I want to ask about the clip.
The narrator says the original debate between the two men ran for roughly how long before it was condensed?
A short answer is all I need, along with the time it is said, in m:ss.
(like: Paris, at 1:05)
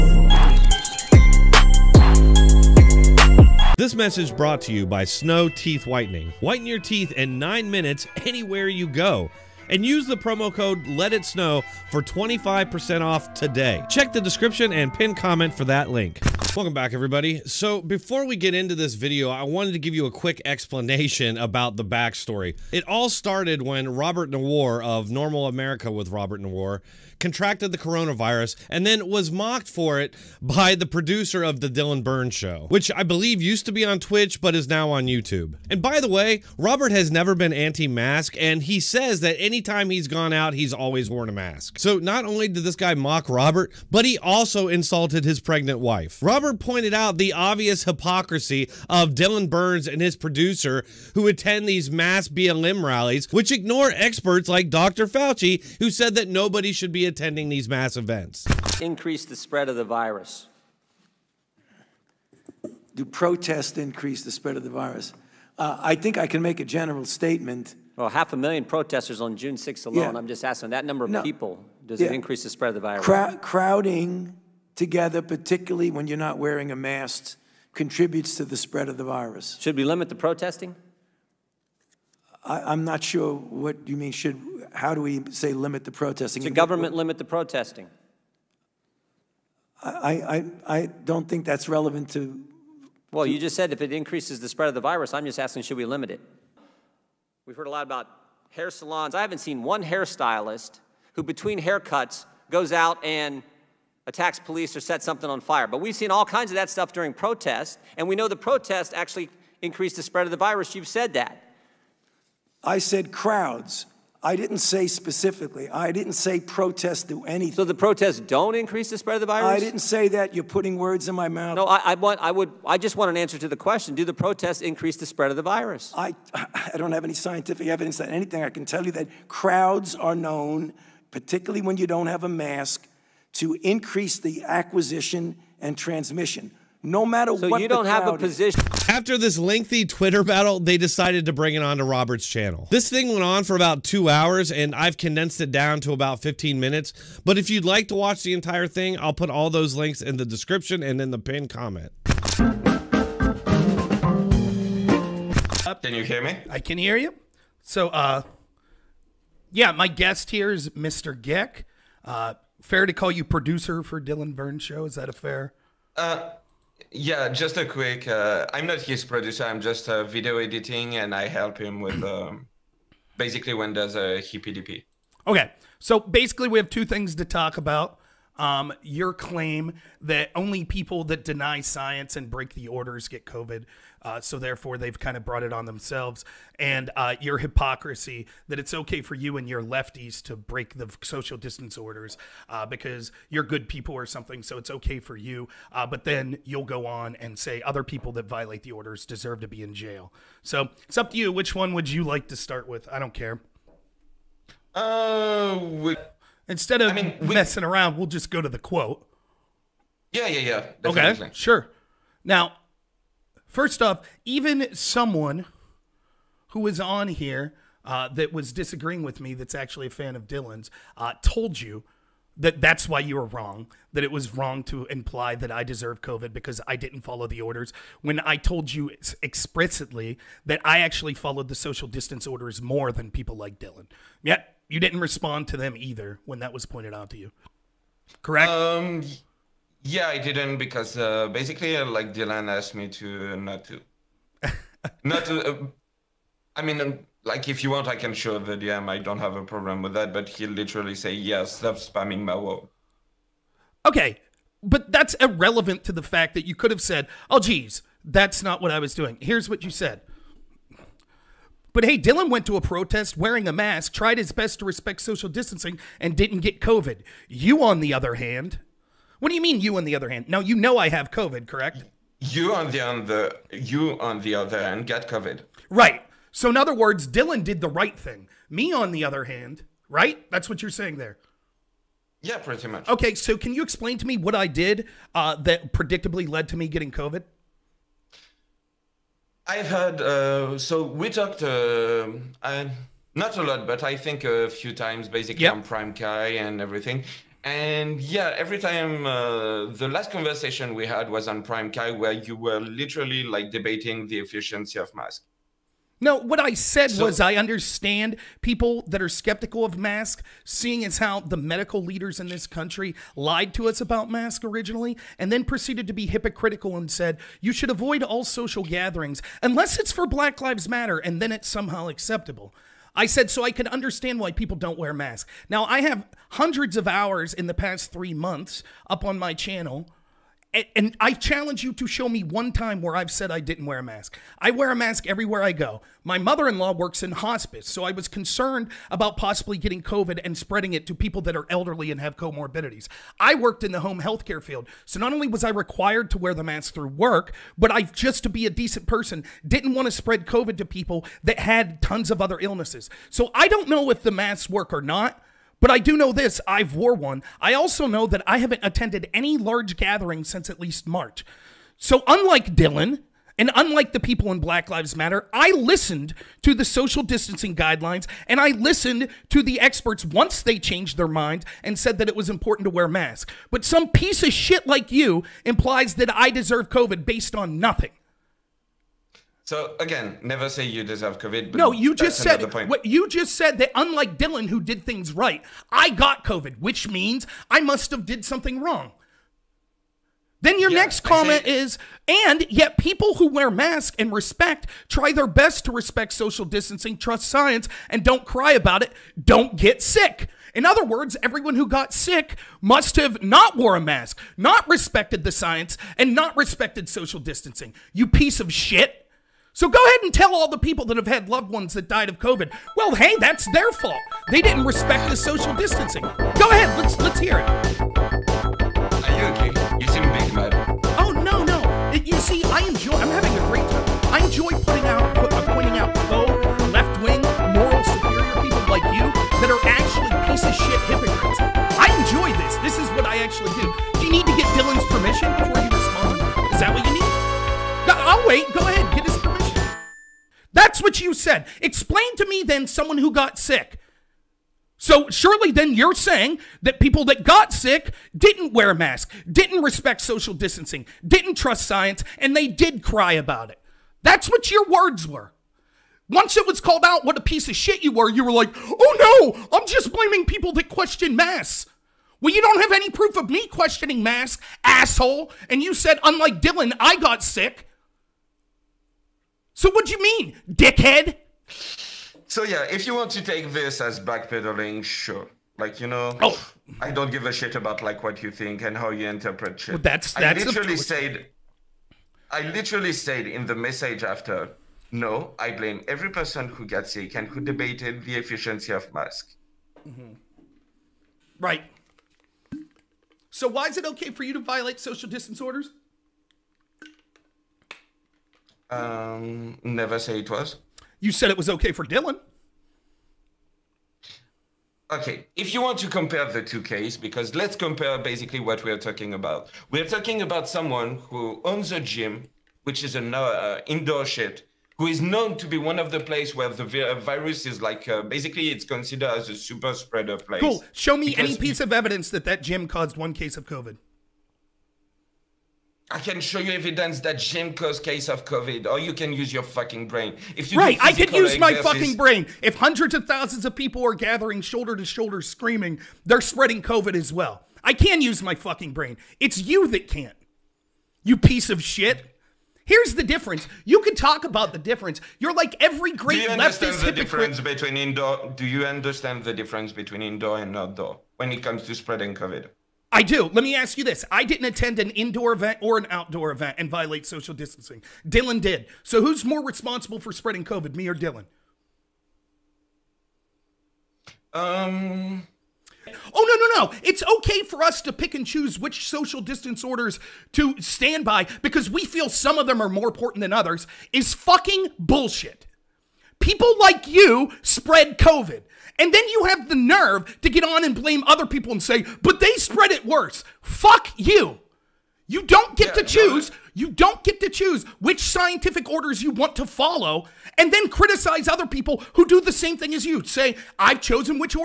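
About 2 hours, at 2:23.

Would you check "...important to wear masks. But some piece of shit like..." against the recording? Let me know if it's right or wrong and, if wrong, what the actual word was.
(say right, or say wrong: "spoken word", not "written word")
right.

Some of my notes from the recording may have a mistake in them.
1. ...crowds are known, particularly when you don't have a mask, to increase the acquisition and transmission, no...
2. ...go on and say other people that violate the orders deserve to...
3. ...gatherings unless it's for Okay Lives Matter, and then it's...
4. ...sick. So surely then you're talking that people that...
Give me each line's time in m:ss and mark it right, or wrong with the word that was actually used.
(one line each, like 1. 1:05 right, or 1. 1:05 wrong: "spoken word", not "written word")
1. 2:09 right
2. 3:16 right
3. 5:18 wrong: "Black", not "Okay"
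4. 7:23 wrong: "saying", not "talking".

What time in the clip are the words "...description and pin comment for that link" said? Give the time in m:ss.
0:14.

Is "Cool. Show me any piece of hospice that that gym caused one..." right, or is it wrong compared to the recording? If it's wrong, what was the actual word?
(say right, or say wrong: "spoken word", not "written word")
wrong: "evidence", not "hospice".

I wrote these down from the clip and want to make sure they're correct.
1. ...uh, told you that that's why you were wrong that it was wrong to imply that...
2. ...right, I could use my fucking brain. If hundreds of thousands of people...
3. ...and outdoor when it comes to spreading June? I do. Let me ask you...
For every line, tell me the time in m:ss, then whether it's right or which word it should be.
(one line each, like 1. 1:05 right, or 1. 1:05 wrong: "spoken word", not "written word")
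1. 3:40 right
2. 8:50 right
3. 9:10 wrong: "COVID", not "June".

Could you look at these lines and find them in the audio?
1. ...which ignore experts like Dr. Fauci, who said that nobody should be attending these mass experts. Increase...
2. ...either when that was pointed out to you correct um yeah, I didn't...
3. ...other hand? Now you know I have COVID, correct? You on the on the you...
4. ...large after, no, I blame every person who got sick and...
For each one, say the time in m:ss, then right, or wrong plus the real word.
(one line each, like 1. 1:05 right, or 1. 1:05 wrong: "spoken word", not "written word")
1. 0:53 wrong: "events", not "experts"
2. 3:55 right
3. 4:29 right
4. 8:03 wrong: "message", not "large".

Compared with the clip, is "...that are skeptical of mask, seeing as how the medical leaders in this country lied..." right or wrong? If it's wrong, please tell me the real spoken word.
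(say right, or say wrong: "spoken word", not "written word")
right.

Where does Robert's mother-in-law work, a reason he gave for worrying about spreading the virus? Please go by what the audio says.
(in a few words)
Hospice.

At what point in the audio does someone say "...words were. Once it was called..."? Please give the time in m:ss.
7:34.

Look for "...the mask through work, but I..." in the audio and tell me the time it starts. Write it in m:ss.
5:46.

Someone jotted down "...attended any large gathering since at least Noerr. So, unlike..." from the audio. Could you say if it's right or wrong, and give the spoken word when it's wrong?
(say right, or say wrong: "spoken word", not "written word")
wrong: "March", not "Noerr".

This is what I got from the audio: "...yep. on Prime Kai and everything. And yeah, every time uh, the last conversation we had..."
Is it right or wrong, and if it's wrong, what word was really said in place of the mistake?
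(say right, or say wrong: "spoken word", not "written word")
right.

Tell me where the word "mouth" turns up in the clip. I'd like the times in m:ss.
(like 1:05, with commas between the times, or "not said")
2:01.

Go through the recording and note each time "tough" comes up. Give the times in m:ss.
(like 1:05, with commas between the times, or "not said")
not said.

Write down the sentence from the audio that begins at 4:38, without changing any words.
Me on the other hand, right?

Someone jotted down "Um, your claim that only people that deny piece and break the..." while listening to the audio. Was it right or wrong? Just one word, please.
wrong.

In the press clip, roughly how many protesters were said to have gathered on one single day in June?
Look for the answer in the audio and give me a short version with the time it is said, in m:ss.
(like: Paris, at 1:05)
Half a million, at 1:08.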